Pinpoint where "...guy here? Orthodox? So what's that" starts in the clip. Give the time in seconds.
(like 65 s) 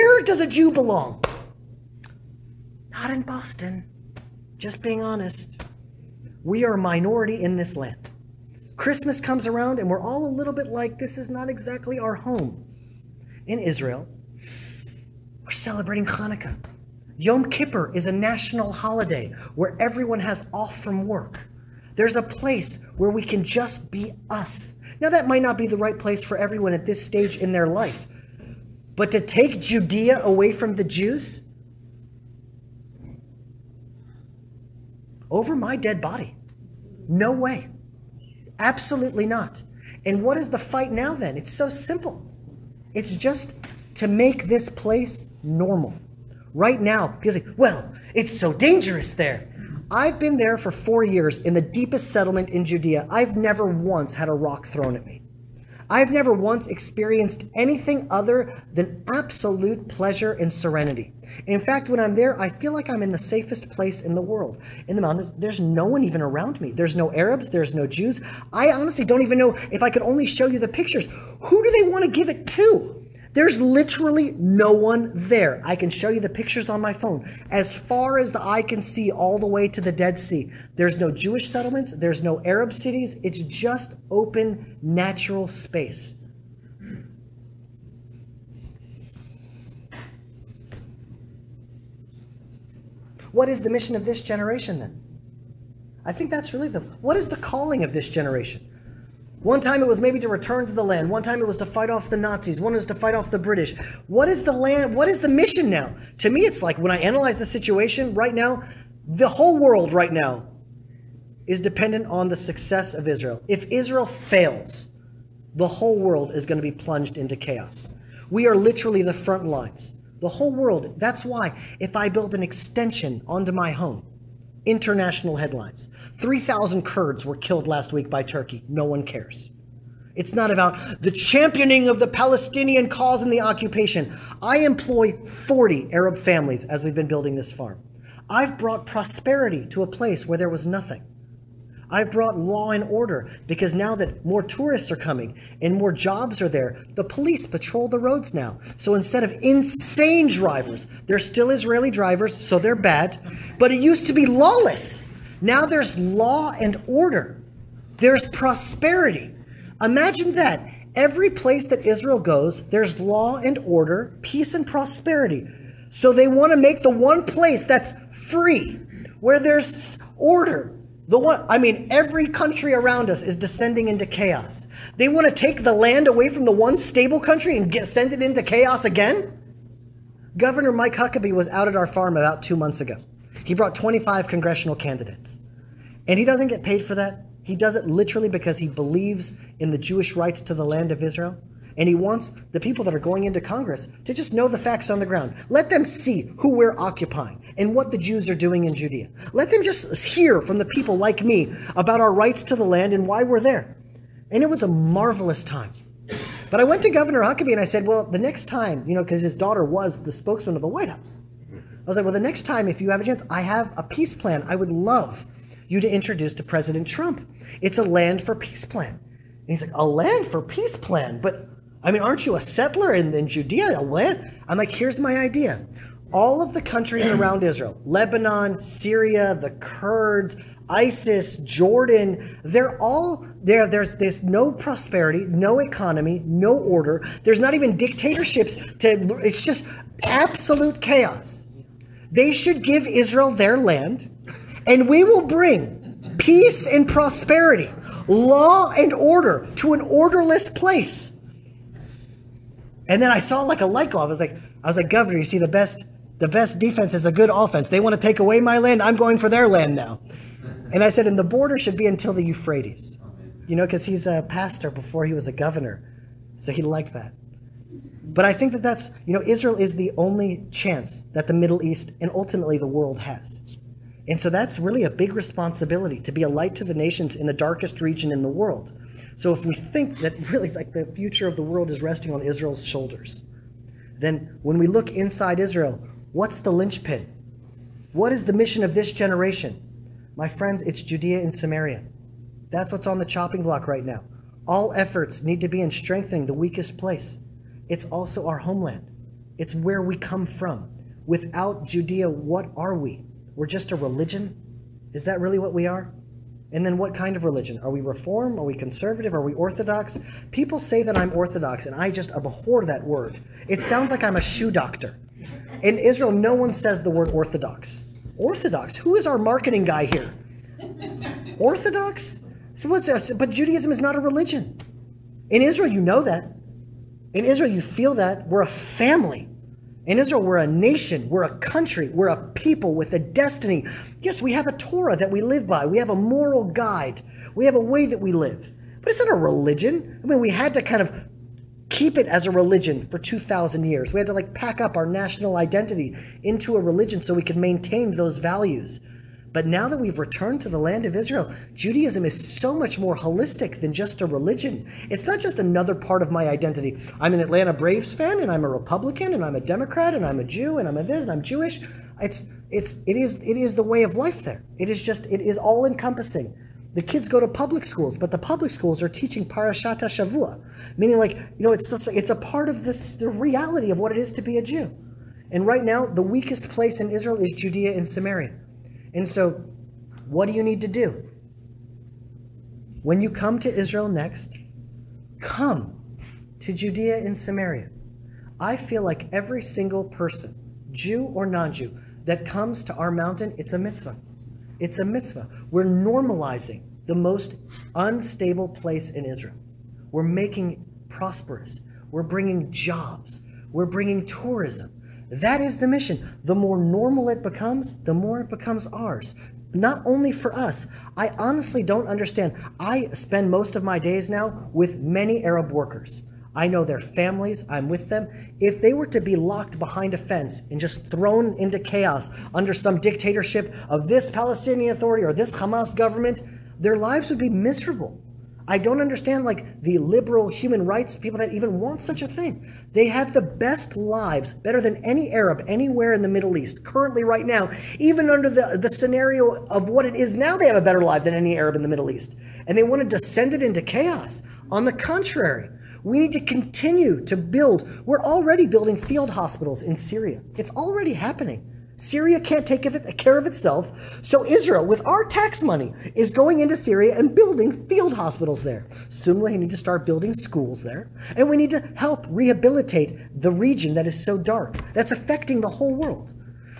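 319 s.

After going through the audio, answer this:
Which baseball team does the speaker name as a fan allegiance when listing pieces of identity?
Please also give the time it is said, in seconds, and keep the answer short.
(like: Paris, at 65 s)
Atlanta Braves, at 357 s.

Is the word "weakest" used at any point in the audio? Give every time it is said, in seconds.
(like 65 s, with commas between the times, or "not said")
296 s, 376 s.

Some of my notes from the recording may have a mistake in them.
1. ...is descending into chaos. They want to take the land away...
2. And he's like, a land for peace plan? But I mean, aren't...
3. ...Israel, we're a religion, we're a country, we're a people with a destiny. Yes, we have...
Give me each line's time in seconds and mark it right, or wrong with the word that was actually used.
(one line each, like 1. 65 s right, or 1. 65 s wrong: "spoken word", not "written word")
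1. 173 s right
2. 218 s right
3. 329 s wrong: "nation", not "religion".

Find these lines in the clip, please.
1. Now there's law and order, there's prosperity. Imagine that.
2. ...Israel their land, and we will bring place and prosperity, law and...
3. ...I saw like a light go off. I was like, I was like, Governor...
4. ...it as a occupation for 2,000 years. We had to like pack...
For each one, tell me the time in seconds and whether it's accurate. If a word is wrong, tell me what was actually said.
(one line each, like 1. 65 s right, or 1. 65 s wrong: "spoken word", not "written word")
1. 155 s right
2. 242 s wrong: "peace", not "place"
3. 253 s right
4. 341 s wrong: "religion", not "occupation".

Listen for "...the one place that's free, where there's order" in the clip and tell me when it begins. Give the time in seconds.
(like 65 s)
166 s.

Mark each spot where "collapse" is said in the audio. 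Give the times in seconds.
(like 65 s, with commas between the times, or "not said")
not said.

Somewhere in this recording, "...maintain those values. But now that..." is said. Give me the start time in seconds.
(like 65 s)
347 s.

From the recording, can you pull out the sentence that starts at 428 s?
I don't understand like the liberal human rights people that even want such a thing.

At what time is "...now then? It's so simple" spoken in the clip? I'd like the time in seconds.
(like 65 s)
40 s.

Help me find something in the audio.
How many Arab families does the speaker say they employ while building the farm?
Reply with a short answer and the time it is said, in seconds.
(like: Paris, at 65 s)
40, at 135 s.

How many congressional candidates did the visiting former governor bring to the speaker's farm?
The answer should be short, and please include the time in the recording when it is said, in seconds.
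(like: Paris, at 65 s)
25, at 183 s.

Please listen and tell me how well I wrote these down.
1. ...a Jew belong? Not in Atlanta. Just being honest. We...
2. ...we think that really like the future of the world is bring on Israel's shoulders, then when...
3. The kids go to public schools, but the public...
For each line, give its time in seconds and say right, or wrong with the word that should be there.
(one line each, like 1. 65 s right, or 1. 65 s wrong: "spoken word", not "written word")
1. 0 s wrong: "Boston", not "Atlanta"
2. 279 s wrong: "resting", not "bring"
3. 366 s right.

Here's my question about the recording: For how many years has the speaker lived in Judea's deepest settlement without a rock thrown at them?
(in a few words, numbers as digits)
4.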